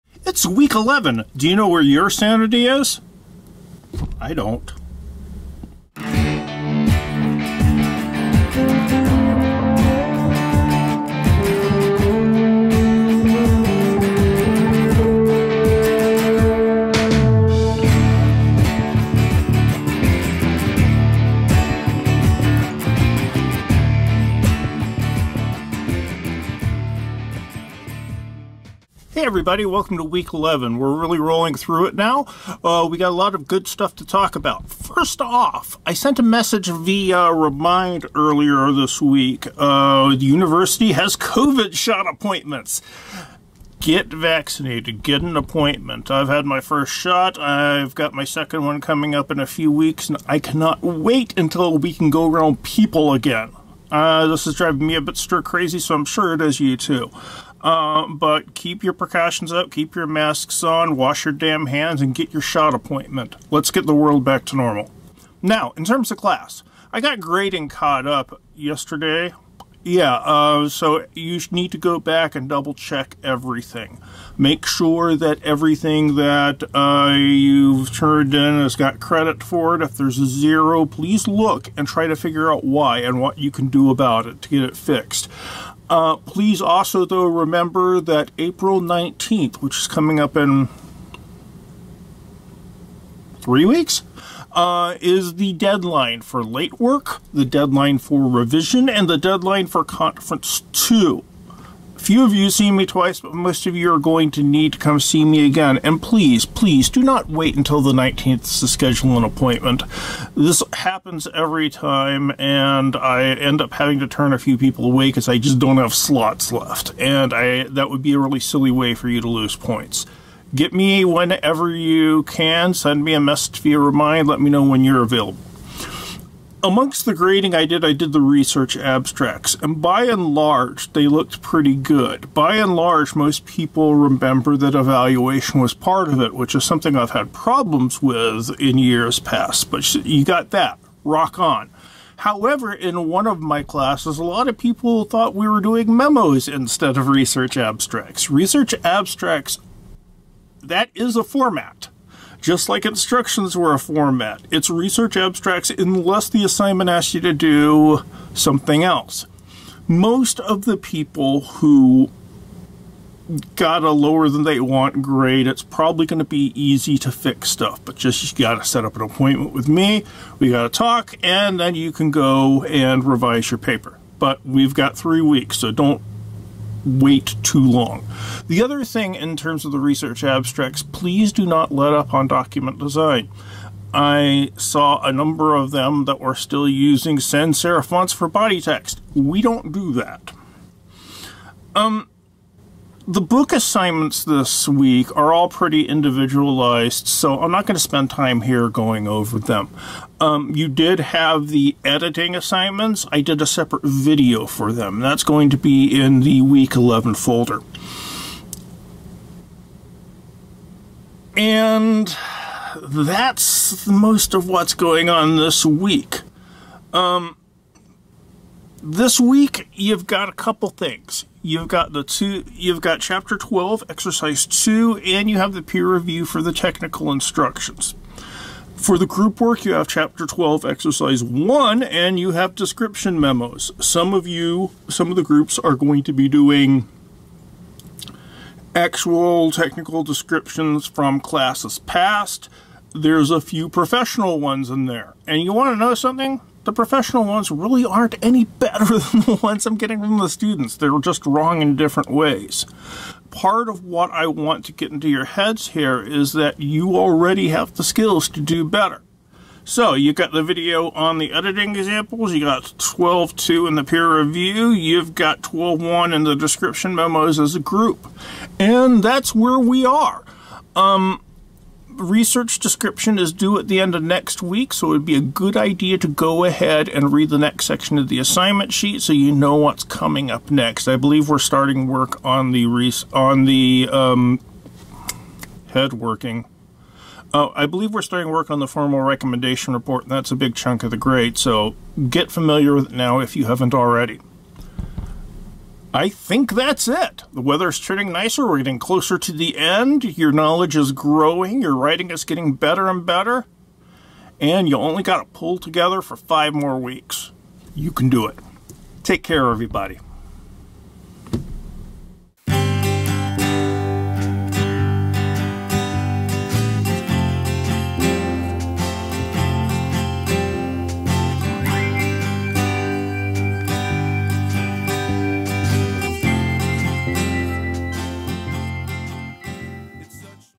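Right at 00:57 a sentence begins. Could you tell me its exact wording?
Uh, but keep your precautions up, keep your masks on, wash your damn hands, and get your shot appointment.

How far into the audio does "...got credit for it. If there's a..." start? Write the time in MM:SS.
01:18.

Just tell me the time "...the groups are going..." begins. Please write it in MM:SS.
03:55.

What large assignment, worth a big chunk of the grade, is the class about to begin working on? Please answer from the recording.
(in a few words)
formal recommendation report.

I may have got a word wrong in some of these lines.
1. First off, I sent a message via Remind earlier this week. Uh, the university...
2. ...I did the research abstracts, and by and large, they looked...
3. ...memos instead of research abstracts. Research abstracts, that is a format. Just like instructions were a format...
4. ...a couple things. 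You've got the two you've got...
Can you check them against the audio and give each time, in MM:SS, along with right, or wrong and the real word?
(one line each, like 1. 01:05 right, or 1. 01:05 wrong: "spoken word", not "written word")
1. 00:34 right
2. 02:07 right
3. 02:25 right
4. 03:40 right.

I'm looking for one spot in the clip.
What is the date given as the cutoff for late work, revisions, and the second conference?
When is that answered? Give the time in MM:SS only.
01:28.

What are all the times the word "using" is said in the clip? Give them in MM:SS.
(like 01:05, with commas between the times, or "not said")
03:06.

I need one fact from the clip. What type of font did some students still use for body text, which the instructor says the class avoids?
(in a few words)
sans serif.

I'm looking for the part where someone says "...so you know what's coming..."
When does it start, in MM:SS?
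04:39.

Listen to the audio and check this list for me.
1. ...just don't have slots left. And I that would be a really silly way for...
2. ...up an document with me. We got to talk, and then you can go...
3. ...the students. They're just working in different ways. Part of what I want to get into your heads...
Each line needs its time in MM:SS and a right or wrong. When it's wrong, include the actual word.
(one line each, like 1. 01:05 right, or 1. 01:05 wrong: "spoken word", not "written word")
1. 01:55 right
2. 02:48 wrong: "appointment", not "document"
3. 04:10 wrong: "wrong", not "working".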